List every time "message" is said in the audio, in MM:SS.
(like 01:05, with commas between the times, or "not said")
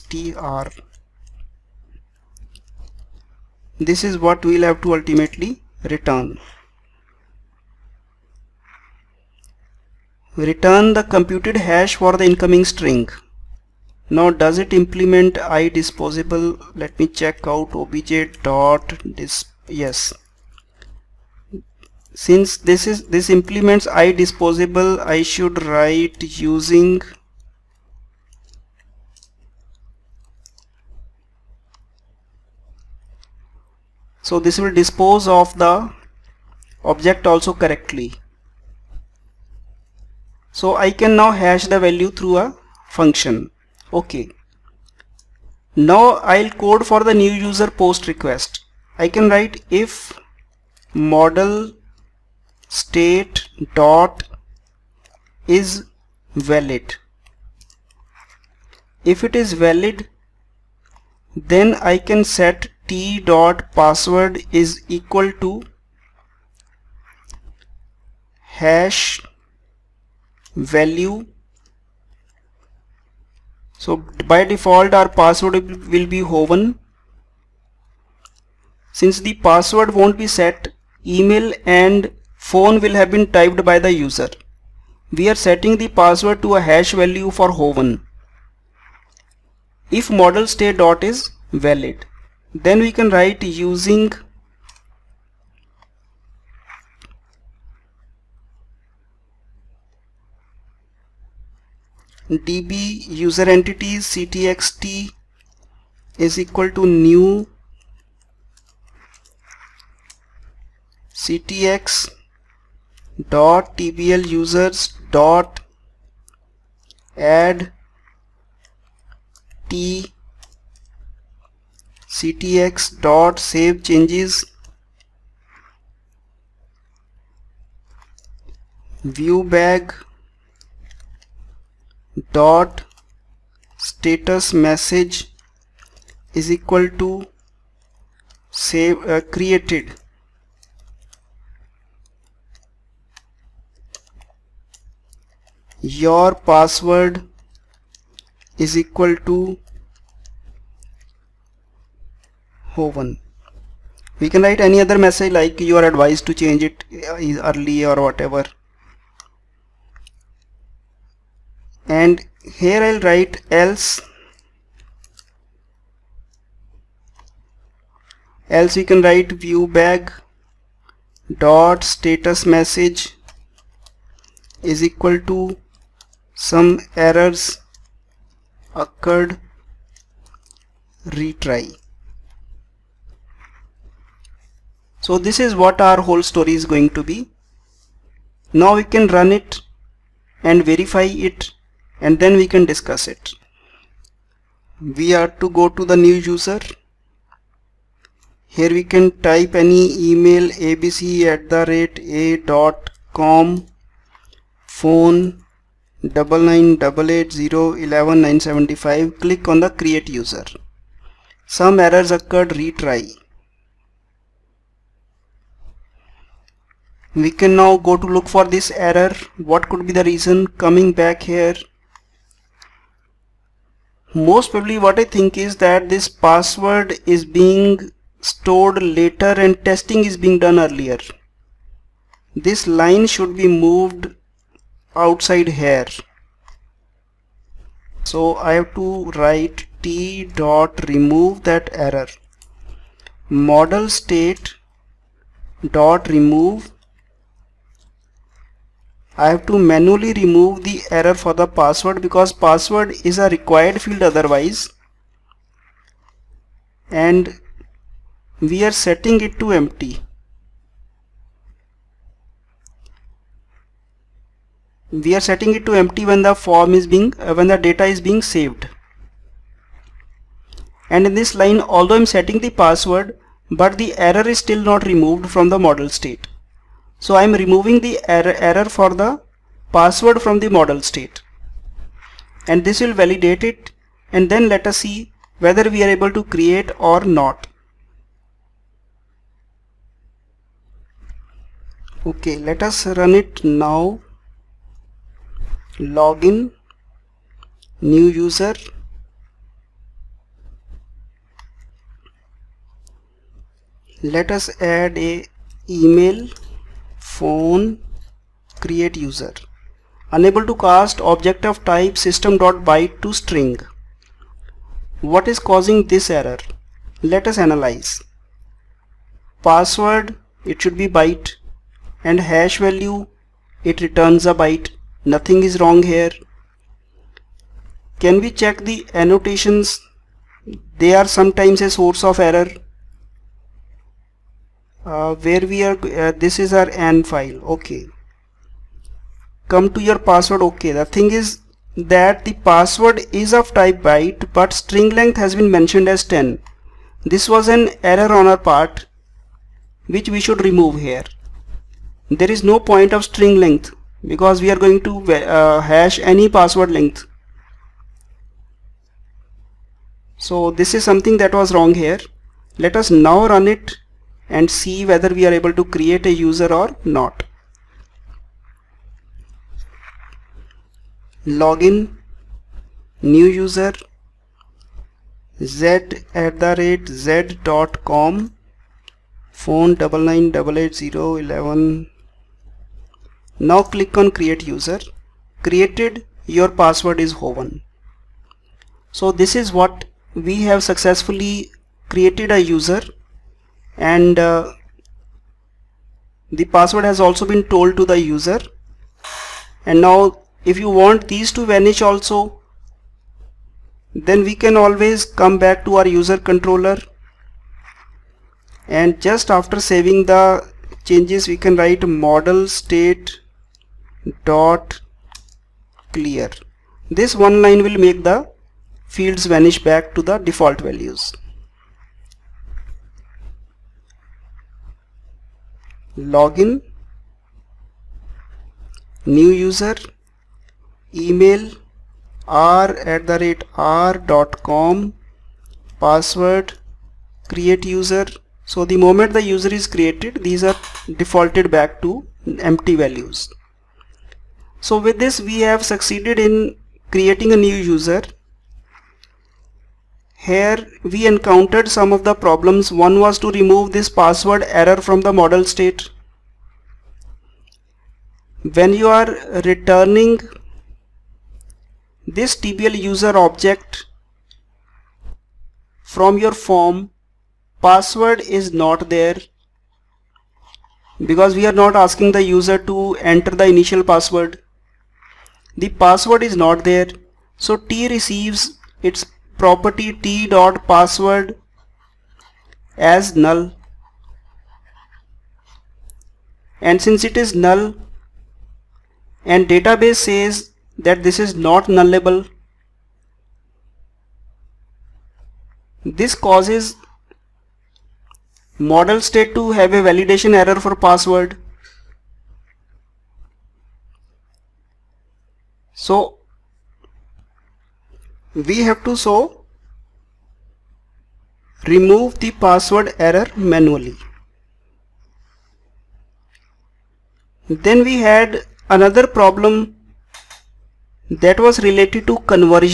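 02:14, 02:34, 02:52.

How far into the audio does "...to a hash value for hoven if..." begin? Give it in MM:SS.
01:26.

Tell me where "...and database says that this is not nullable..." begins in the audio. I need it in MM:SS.
08:09.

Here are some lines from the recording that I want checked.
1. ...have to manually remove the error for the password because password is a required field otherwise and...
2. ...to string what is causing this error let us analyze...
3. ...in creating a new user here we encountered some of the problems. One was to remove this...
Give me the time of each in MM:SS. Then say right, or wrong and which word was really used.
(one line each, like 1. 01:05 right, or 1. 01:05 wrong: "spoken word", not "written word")
1. 04:09 right
2. 05:13 right
3. 07:26 right.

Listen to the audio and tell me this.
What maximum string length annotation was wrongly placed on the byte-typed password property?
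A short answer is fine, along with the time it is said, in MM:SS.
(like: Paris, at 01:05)
10, at 05:46.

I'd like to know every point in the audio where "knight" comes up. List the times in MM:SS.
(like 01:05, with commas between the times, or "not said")
not said.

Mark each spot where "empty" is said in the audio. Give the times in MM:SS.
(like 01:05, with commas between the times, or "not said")
04:19, 04:25, 07:22.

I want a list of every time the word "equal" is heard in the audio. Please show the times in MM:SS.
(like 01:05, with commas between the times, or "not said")
01:04, 01:46, 02:16, 02:28, 02:54.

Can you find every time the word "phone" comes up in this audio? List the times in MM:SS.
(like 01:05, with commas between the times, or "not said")
01:22, 03:24, 05:07, 06:19.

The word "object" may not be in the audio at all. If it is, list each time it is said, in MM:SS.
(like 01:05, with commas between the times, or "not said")
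00:36, 05:11, 07:43.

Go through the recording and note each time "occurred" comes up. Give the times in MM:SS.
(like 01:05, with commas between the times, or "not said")
02:58, 03:32.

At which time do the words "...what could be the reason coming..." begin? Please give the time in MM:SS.
03:39.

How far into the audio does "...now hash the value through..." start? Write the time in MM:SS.
00:41.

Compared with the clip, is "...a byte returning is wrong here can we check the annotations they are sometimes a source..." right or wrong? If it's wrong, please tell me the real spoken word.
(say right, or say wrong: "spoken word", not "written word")
wrong: "nothing", not "returning".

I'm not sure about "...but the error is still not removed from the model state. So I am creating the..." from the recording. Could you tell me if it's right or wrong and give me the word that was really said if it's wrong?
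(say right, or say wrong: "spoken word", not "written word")
wrong: "removing", not "creating".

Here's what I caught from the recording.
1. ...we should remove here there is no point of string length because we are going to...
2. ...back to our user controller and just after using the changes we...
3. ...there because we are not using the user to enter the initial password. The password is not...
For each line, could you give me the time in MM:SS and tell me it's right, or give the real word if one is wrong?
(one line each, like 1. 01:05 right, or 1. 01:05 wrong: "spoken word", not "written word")
1. 05:50 right
2. 06:45 wrong: "saving", not "using"
3. 07:48 wrong: "asking", not "using".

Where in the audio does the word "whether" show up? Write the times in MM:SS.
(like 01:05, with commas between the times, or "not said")
04:45, 06:04.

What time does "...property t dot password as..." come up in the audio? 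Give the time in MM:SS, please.
07:59.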